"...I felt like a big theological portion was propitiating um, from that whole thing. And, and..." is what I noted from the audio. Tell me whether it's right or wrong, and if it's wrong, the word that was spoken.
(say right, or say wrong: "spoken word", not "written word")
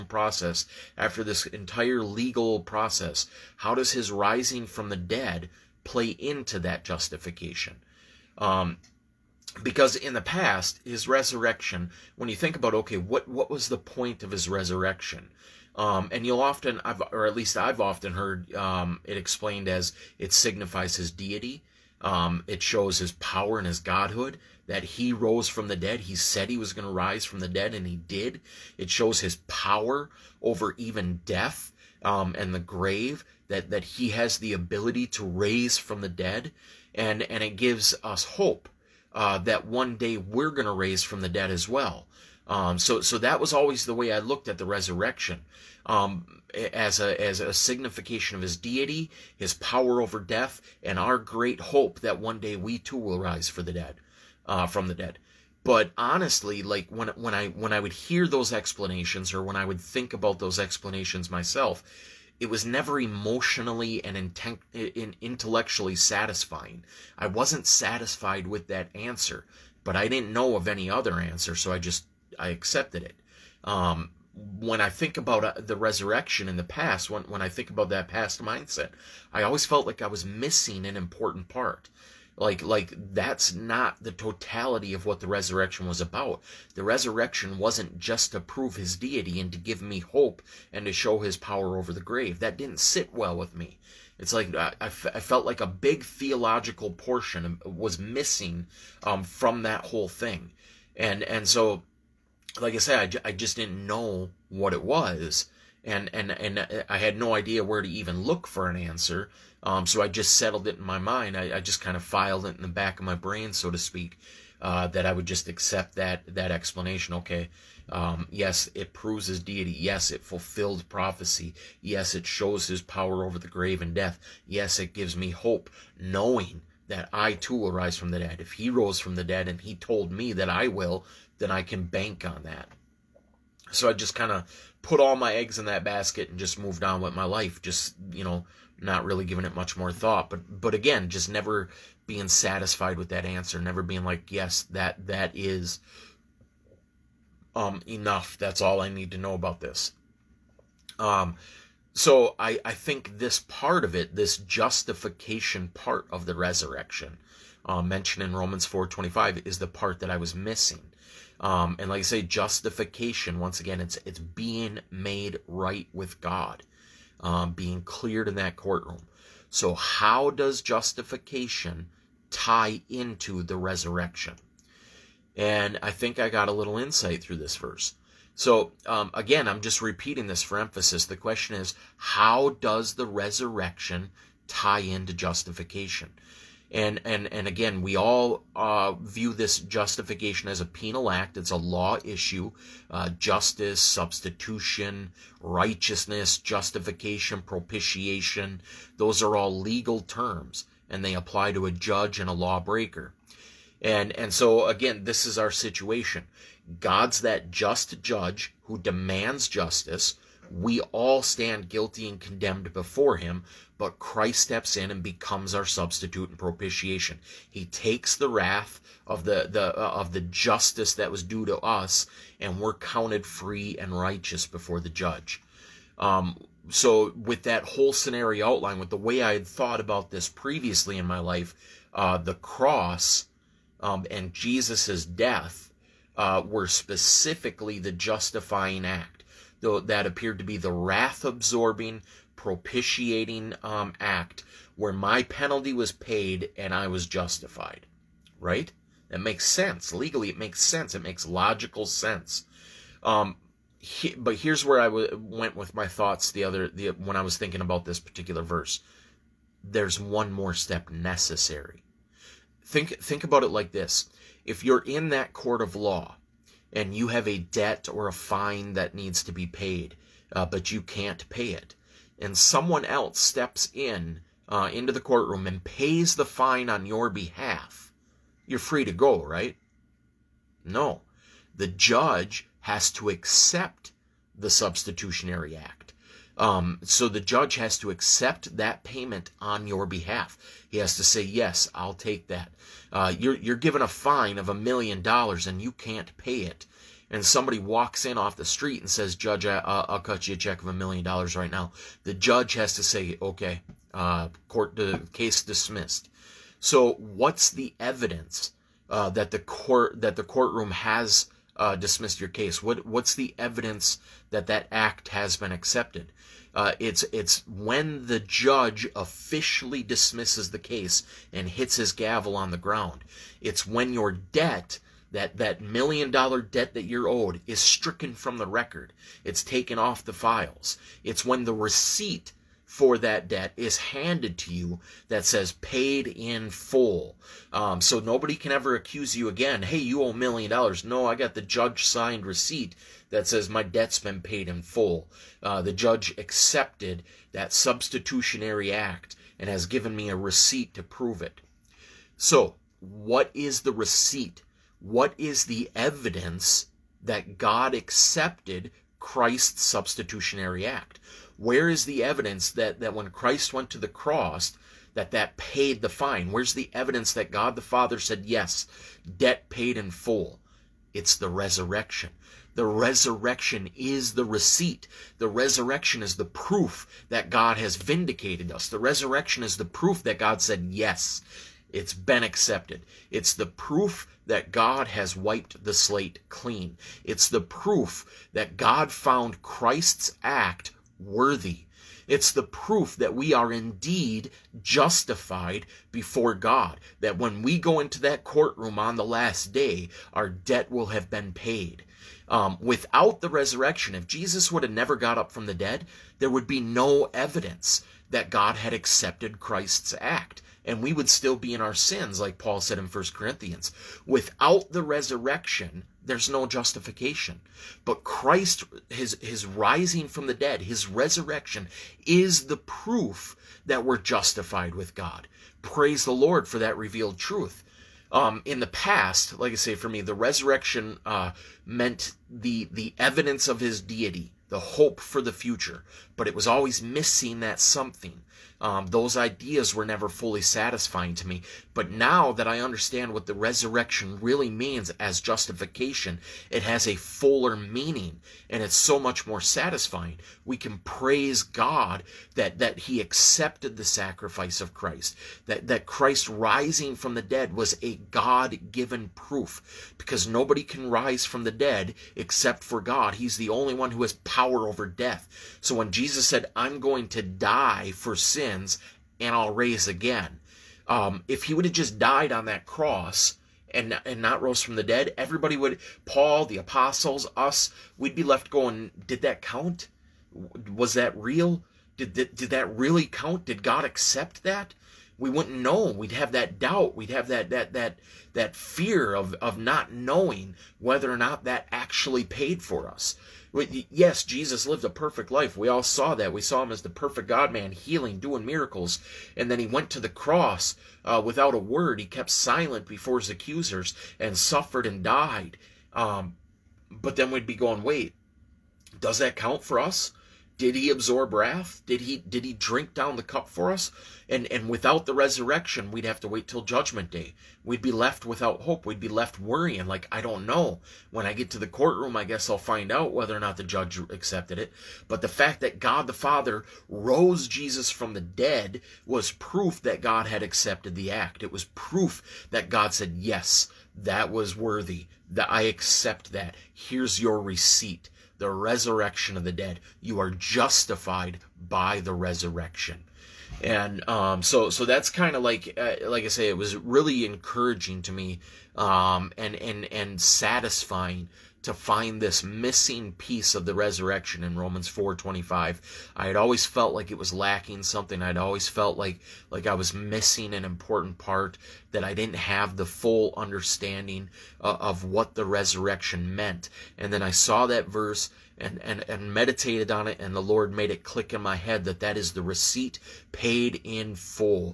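wrong: "missing", not "propitiating".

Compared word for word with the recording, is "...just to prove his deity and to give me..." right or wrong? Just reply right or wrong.
right.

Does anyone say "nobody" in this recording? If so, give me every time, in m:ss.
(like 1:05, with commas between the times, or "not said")
5:38, 7:40.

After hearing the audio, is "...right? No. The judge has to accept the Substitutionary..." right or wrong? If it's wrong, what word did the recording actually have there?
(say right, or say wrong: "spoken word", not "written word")
right.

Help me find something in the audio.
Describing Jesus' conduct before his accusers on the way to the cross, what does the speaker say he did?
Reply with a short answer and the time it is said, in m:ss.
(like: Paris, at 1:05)
kept silent, at 8:22.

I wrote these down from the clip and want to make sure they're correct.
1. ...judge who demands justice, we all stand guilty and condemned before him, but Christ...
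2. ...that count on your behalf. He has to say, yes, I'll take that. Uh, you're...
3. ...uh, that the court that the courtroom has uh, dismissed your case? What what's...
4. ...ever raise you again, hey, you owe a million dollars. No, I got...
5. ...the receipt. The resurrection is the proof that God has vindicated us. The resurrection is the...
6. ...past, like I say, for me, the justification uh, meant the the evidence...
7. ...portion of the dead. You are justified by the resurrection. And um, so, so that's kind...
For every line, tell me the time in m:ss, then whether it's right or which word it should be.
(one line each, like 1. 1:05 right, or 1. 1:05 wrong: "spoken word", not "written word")
1. 3:28 right
2. 4:48 wrong: "payment", not "count"
3. 5:08 right
4. 5:38 wrong: "accuse", not "raise"
5. 6:14 right
6. 7:08 wrong: "resurrection", not "justification"
7. 8:58 wrong: "resurrection", not "portion".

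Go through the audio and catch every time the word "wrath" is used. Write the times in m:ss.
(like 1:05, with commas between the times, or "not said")
3:38, 4:00, 8:31.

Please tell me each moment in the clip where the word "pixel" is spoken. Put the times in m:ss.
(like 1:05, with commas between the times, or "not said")
not said.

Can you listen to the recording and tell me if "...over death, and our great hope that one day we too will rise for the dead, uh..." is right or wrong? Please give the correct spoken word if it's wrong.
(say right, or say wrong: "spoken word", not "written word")
right.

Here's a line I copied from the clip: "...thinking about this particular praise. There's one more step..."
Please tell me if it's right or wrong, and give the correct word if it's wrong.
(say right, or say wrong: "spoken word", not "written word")
wrong: "verse", not "praise".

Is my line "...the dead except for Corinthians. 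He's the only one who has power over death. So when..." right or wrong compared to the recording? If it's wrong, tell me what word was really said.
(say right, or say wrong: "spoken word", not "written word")
wrong: "God", not "Corinthians".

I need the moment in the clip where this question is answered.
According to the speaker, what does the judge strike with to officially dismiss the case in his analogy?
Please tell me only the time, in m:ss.
5:21.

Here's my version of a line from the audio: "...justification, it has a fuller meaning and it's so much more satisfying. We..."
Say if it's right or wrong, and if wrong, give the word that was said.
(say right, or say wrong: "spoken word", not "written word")
right.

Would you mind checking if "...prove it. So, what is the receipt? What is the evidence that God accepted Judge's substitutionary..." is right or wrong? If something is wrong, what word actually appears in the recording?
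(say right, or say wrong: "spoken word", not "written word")
wrong: "Christ", not "Judge".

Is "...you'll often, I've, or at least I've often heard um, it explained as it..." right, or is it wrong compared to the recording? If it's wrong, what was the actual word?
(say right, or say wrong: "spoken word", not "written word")
right.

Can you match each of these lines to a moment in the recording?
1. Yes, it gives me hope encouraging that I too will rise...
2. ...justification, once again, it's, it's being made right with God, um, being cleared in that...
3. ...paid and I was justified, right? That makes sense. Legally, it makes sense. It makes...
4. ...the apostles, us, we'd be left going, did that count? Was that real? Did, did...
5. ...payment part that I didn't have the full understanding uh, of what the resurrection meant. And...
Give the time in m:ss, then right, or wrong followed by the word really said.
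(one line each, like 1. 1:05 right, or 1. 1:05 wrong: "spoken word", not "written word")
1. 2:04 wrong: "knowing", not "encouraging"
2. 2:42 right
3. 4:05 right
4. 7:56 right
5. 9:20 wrong: "important", not "payment".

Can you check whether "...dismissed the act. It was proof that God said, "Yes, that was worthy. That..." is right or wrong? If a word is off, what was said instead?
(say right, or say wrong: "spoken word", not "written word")
wrong: "accepted", not "dismissed".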